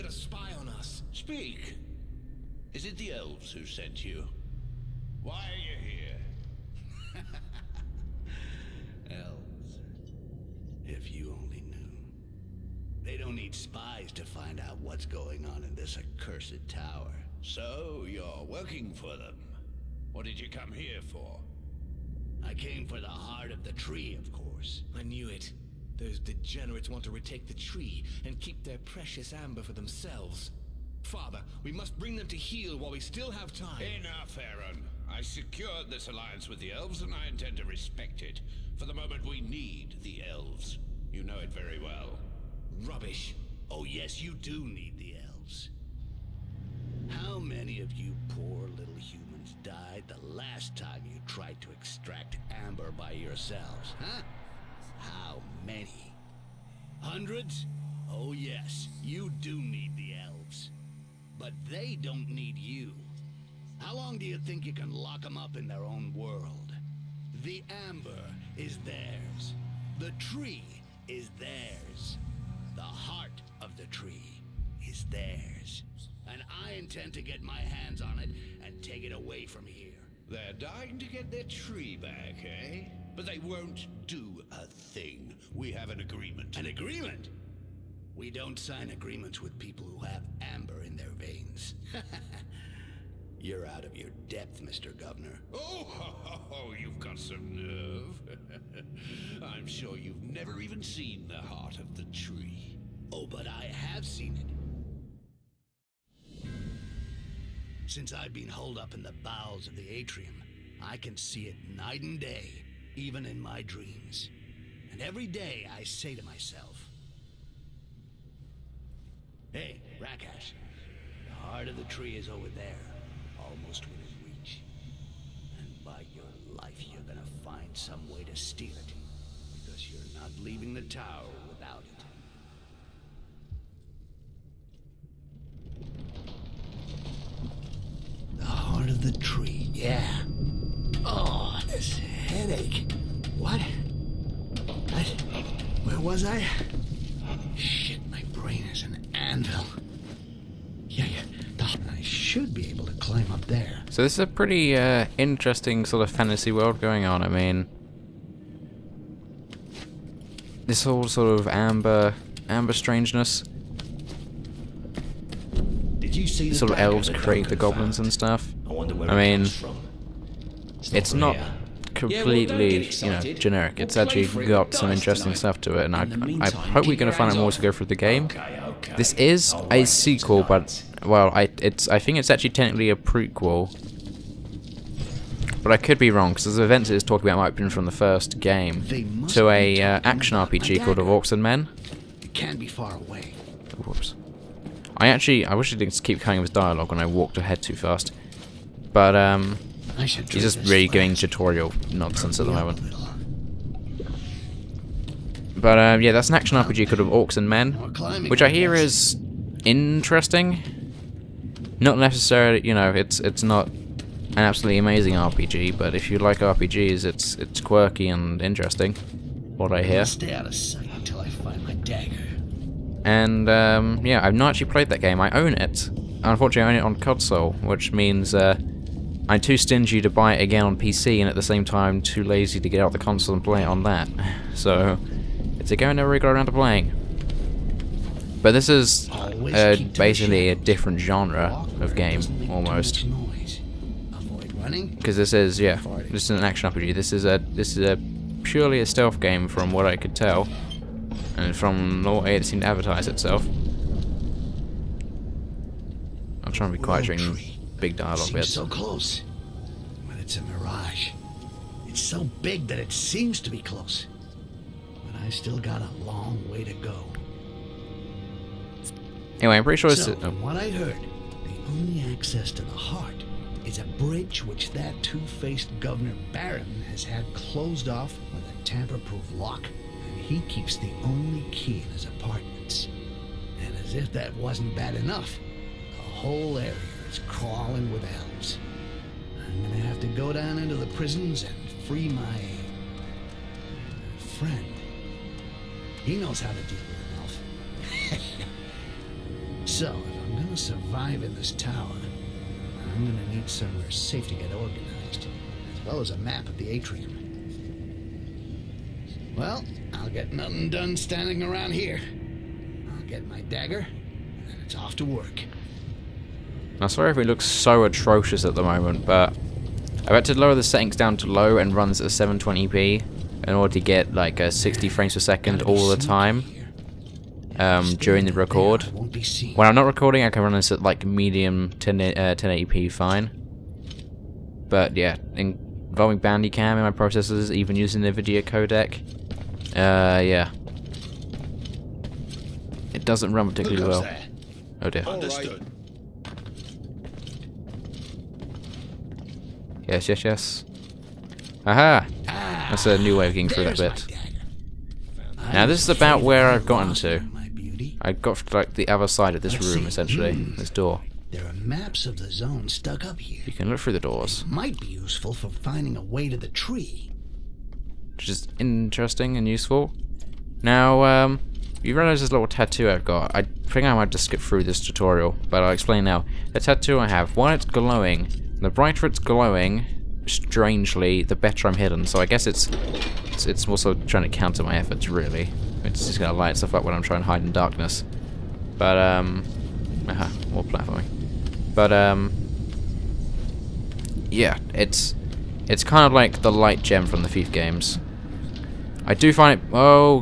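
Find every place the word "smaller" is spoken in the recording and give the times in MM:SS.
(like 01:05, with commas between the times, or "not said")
not said.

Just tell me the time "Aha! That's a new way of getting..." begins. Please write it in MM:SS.
05:51.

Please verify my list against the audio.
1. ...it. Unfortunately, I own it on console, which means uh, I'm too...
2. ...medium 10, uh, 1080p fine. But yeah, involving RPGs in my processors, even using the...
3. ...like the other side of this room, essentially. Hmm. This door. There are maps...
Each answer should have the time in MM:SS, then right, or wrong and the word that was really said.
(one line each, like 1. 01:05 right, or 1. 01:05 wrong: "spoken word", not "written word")
1. 03:45 right
2. 05:31 wrong: "Bandicam", not "RPGs"
3. 05:58 right.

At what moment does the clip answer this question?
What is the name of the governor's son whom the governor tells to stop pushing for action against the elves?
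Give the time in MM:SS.
00:34.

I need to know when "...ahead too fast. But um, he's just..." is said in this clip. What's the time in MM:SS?
03:17.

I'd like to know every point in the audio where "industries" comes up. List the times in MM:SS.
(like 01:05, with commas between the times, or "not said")
not said.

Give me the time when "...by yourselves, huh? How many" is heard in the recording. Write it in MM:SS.
00:52.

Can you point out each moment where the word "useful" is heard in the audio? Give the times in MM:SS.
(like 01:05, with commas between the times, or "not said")
06:04, 06:09.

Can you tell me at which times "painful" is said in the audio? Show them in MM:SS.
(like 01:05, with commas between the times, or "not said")
not said.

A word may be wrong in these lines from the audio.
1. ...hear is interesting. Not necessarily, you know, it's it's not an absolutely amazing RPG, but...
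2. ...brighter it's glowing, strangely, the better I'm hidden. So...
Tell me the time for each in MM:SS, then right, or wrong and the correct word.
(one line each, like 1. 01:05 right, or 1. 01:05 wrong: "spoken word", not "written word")
1. 03:28 right
2. 06:18 right.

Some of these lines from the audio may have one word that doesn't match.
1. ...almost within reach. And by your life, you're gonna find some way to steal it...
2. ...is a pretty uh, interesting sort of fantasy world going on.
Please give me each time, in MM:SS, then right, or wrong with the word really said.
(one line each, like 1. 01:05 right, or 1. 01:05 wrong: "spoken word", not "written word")
1. 02:03 right
2. 02:34 right.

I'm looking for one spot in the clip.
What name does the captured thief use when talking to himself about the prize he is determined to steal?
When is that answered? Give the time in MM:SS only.
02:00.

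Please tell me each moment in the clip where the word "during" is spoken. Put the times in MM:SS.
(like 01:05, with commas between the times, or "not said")
04:17, 05:27.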